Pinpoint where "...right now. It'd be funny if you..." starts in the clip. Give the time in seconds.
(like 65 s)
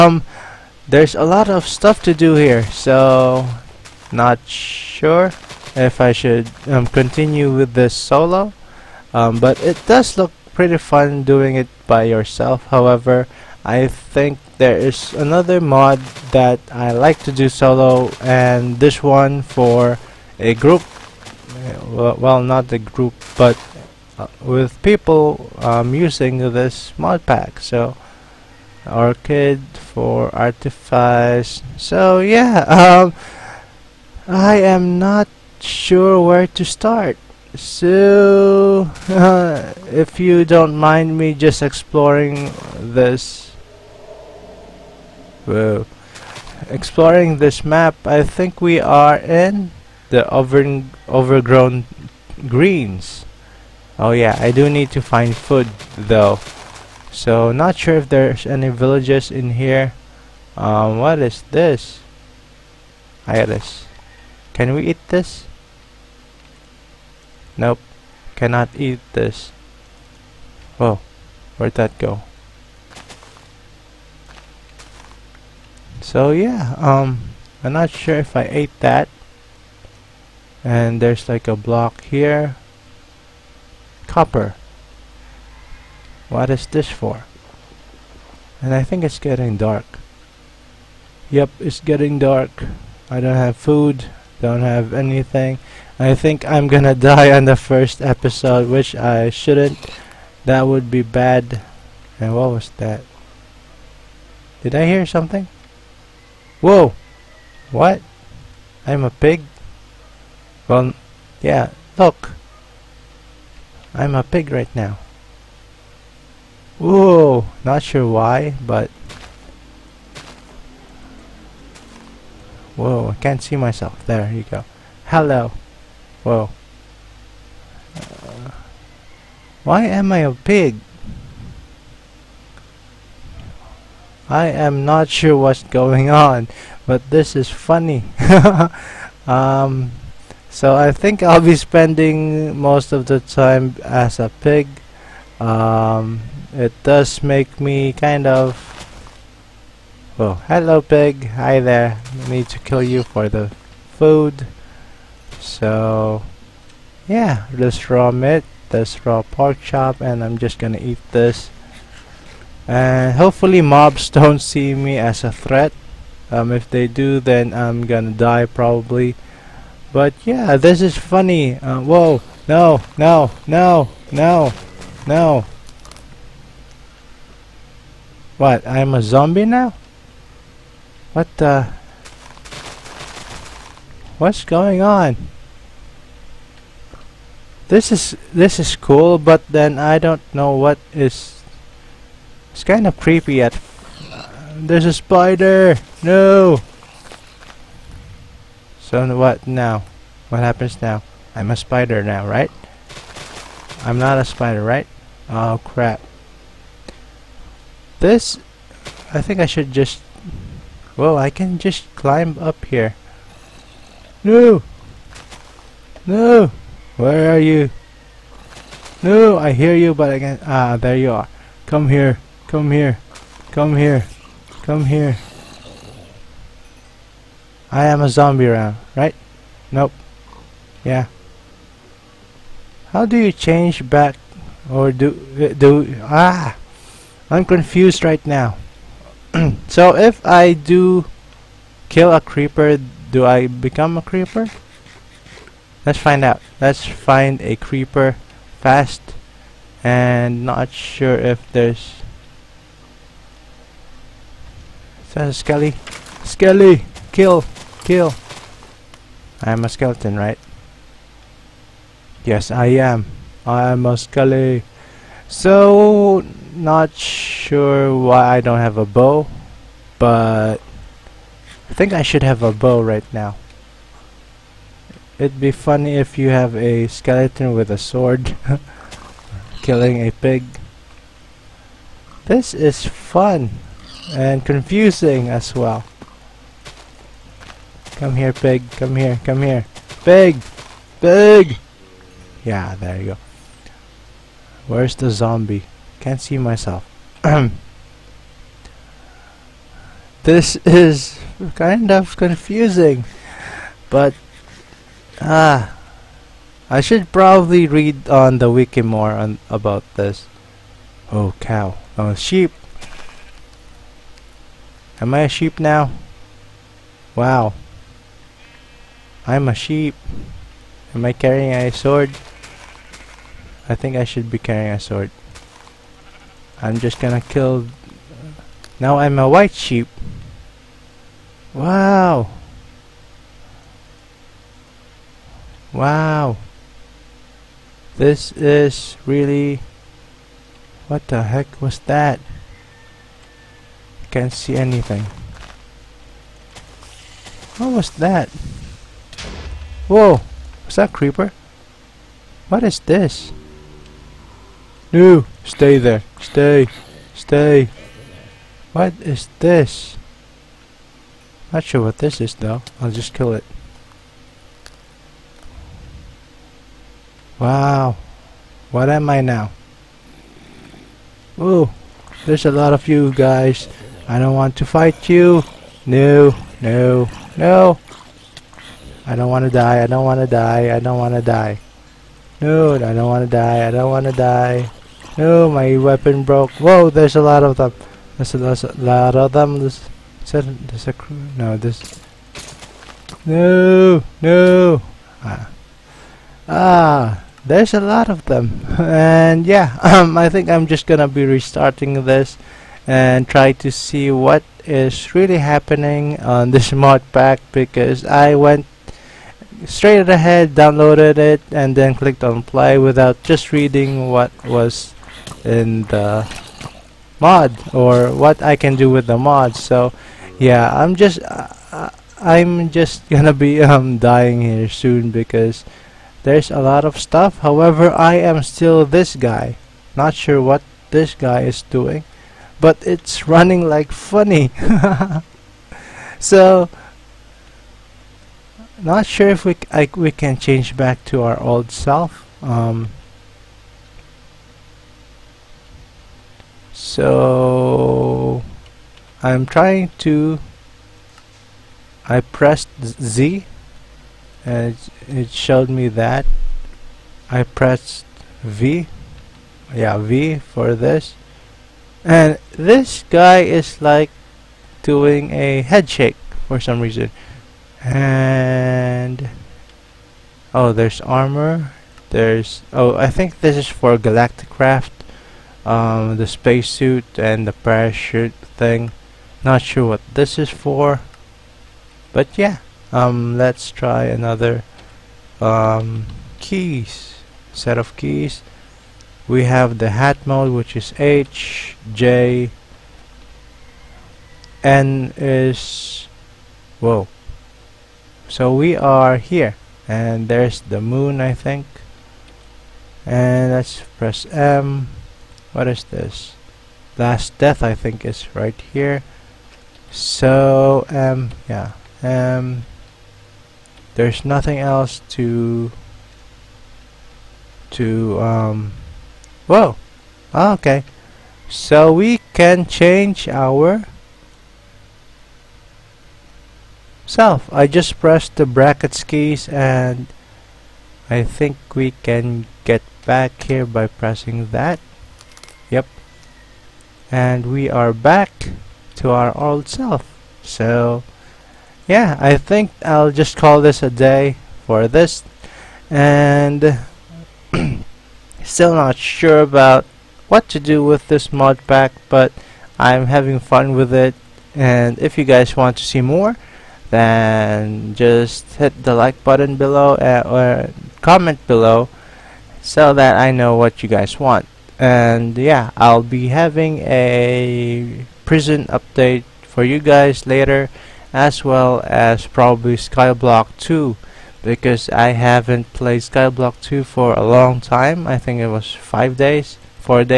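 272 s.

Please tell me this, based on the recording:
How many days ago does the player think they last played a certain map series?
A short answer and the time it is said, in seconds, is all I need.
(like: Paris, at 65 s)
5, at 578 s.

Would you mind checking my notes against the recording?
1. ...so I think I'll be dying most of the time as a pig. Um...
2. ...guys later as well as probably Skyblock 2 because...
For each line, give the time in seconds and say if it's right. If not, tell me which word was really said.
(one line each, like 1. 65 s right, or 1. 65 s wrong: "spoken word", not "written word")
1. 140 s wrong: "spending", not "dying"
2. 569 s right.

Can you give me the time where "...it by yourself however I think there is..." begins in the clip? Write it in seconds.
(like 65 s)
11 s.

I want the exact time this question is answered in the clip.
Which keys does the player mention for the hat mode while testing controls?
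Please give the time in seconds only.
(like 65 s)
490 s.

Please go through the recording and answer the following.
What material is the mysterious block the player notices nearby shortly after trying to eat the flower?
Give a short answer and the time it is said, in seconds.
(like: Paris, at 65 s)
Copper, at 84 s.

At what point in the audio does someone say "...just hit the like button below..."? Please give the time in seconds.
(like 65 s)
557 s.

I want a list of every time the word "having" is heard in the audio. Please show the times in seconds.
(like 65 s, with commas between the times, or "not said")
553 s, 566 s.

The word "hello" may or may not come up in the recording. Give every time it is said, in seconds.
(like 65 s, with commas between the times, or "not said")
125 s, 150 s.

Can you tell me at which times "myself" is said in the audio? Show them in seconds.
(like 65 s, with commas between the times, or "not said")
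123 s, 296 s.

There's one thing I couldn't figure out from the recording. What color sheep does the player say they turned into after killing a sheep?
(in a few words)
White.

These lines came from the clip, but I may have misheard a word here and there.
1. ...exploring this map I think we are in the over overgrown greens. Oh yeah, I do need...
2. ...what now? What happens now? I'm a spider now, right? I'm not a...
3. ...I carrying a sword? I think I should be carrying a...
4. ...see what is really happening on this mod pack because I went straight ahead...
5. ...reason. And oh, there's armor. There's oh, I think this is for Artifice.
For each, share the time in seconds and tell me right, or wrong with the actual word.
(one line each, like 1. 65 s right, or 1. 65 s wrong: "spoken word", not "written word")
1. 46 s right
2. 199 s right
3. 321 s right
4. 403 s right
5. 466 s wrong: "Galacticraft", not "Artifice".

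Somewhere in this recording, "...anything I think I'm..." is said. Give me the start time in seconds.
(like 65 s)
94 s.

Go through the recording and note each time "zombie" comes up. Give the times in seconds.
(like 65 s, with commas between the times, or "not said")
179 s, 228 s, 295 s.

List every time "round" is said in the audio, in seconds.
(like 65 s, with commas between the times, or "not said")
228 s.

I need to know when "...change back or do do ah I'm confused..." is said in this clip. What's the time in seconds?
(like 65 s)
233 s.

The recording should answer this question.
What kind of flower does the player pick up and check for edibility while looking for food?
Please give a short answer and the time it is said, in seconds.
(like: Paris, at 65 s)
Iris, at 63 s.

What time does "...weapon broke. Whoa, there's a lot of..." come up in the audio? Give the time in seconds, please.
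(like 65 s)
385 s.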